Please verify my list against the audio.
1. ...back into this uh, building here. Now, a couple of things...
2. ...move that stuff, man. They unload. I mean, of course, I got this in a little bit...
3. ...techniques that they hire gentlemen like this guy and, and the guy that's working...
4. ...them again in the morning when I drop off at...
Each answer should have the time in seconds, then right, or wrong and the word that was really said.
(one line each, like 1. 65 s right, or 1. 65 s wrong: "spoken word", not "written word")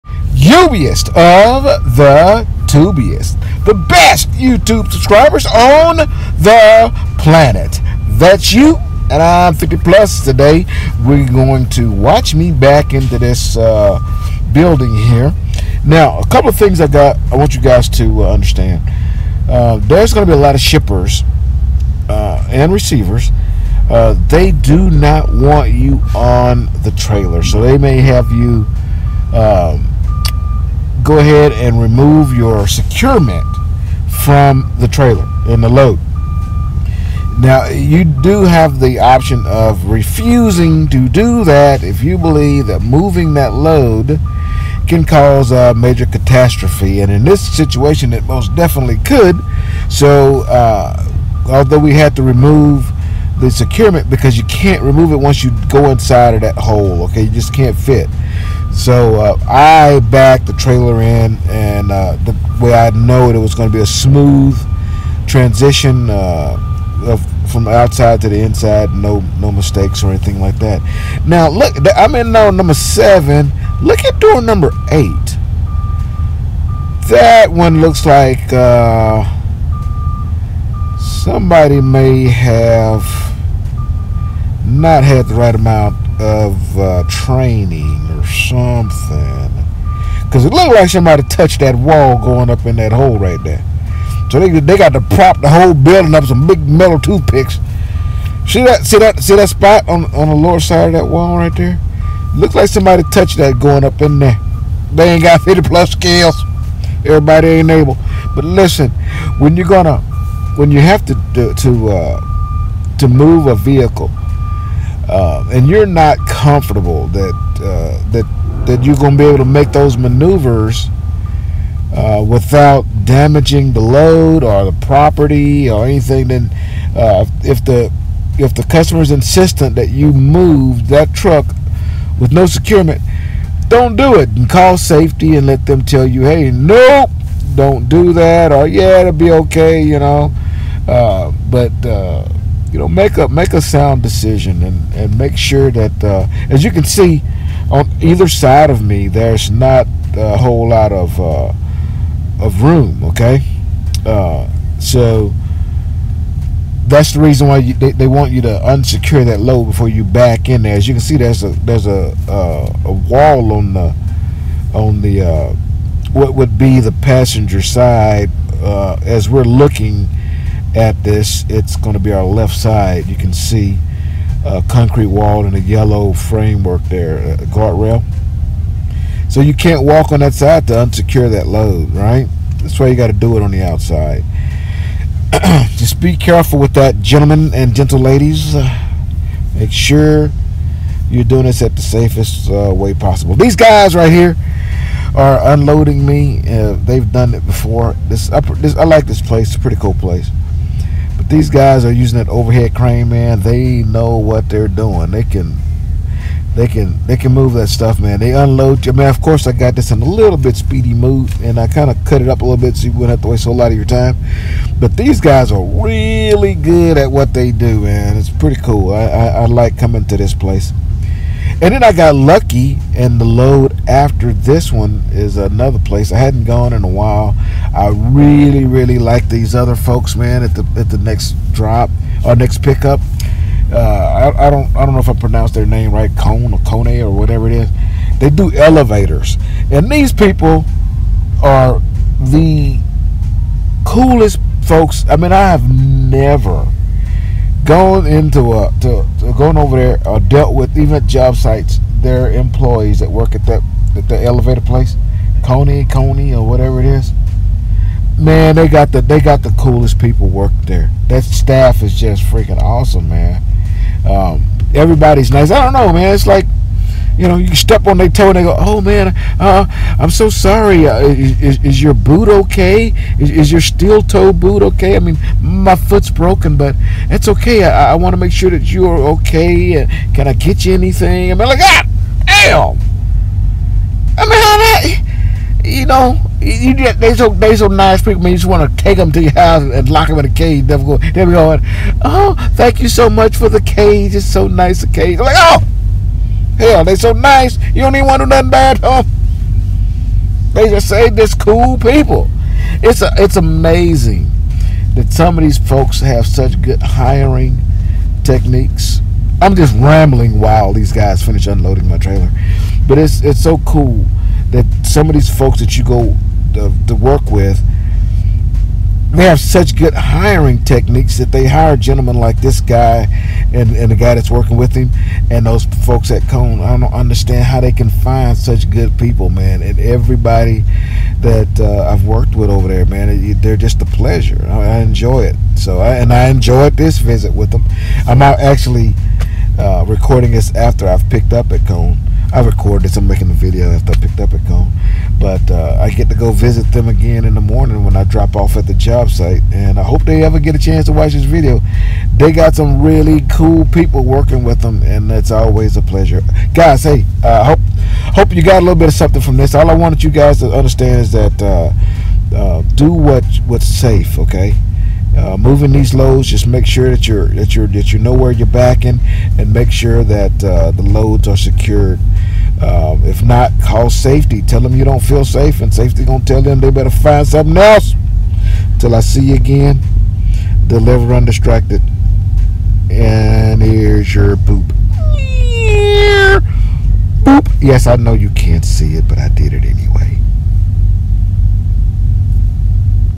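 1. 12 s right
2. 207 s right
3. 320 s right
4. 346 s right.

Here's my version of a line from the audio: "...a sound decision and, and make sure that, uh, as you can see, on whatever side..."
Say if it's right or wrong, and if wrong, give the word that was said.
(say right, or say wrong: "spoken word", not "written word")
wrong: "either", not "whatever".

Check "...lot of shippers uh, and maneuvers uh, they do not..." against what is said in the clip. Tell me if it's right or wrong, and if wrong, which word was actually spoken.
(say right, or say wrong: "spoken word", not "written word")
wrong: "receivers", not "maneuvers".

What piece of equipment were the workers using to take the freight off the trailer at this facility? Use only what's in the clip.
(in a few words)
Overhead crane.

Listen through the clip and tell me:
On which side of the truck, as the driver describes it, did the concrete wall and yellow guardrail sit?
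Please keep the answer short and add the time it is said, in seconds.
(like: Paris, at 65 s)
Left side, at 172 s.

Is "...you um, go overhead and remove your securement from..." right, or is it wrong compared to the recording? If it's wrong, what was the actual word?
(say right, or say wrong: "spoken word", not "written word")
wrong: "ahead", not "overhead".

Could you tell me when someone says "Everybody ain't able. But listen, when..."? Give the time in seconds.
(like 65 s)
107 s.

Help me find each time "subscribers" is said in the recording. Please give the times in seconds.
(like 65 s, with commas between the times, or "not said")
4 s.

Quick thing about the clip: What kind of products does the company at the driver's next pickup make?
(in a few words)
Elevators.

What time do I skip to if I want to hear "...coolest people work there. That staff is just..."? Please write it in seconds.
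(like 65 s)
259 s.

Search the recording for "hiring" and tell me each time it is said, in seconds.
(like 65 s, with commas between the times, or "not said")
306 s, 319 s.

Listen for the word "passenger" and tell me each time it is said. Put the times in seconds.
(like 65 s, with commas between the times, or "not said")
167 s.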